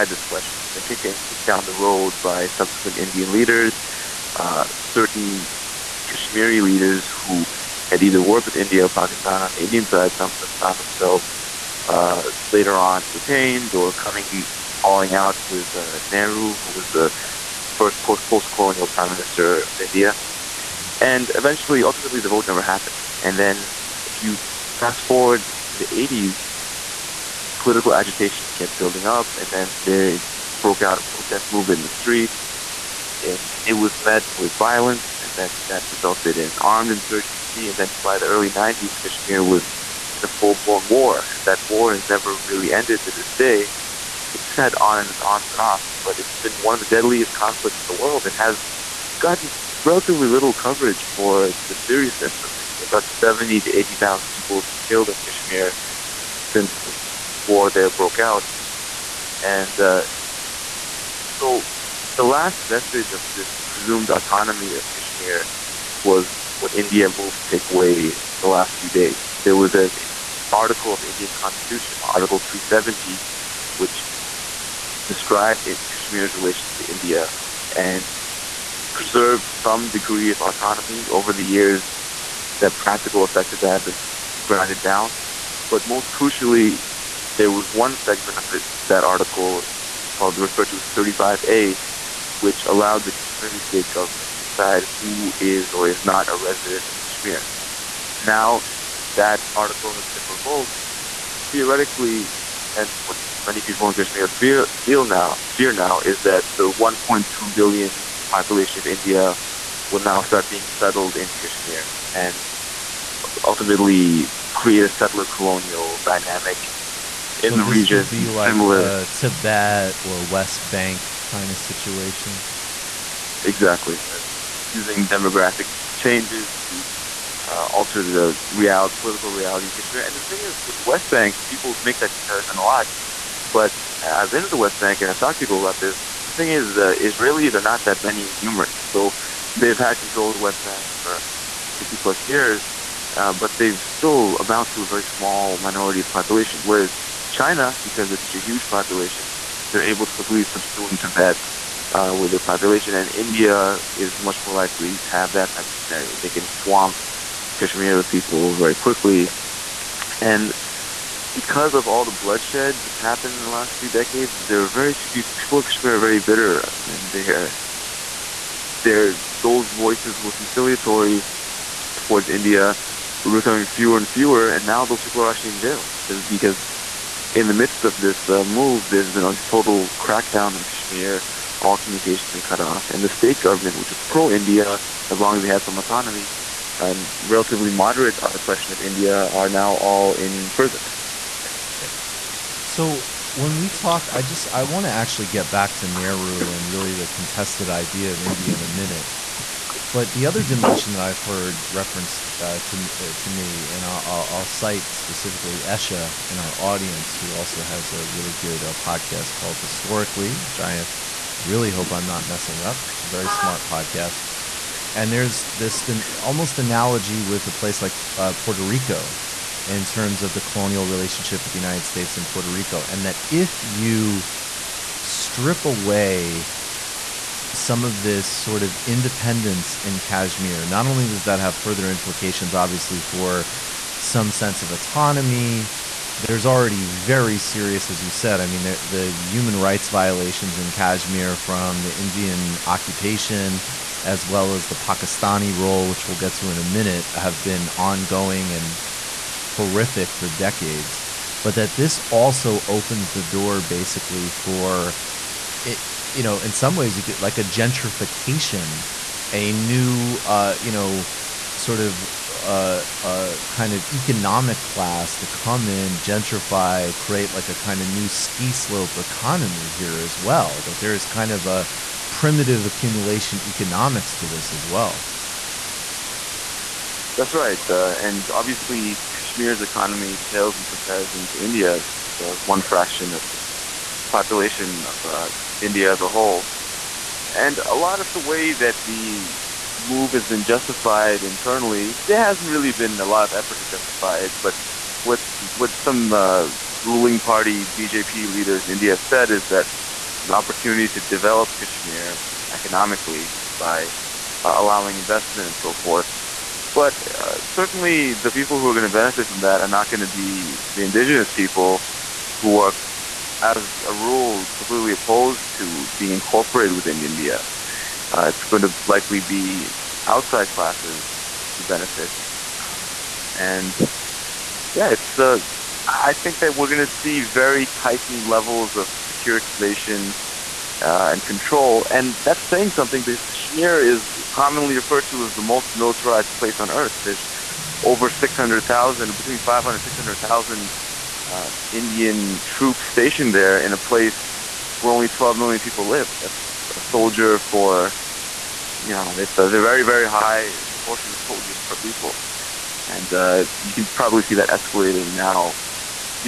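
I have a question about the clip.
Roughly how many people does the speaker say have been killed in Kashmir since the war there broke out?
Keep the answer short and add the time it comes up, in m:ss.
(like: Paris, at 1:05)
70 to 80,000, at 0:53.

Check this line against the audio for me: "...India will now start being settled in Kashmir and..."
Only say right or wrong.
right.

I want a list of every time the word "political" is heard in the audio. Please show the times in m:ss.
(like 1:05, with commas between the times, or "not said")
0:27, 2:08.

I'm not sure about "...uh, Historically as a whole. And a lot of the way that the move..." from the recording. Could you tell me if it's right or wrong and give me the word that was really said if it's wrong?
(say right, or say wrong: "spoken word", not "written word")
wrong: "India", not "Historically".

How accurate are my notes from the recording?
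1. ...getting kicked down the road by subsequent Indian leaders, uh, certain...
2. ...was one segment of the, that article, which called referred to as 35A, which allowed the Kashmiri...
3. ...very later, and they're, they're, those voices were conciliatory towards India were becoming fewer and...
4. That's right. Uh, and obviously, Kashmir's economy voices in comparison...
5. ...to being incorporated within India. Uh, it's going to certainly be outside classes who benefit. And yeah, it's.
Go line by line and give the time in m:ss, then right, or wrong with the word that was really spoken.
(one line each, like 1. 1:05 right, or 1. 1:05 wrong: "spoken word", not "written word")
1. 0:01 right
2. 1:27 right
3. 2:45 wrong: "bitter", not "later"
4. 4:37 wrong: "pales", not "voices"
5. 5:15 wrong: "likely", not "certainly".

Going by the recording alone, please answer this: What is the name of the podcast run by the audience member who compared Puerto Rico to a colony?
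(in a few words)
Historically.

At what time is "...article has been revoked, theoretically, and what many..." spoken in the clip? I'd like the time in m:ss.
1:39.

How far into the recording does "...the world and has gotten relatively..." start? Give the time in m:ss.
0:47.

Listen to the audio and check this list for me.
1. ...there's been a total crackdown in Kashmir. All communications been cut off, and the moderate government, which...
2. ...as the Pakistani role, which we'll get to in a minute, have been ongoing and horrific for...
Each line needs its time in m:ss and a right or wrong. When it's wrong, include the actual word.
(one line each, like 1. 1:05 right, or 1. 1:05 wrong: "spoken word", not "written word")
1. 2:58 wrong: "state", not "moderate"
2. 4:04 right.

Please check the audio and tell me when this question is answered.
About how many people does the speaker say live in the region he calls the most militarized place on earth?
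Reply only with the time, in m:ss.
5:45.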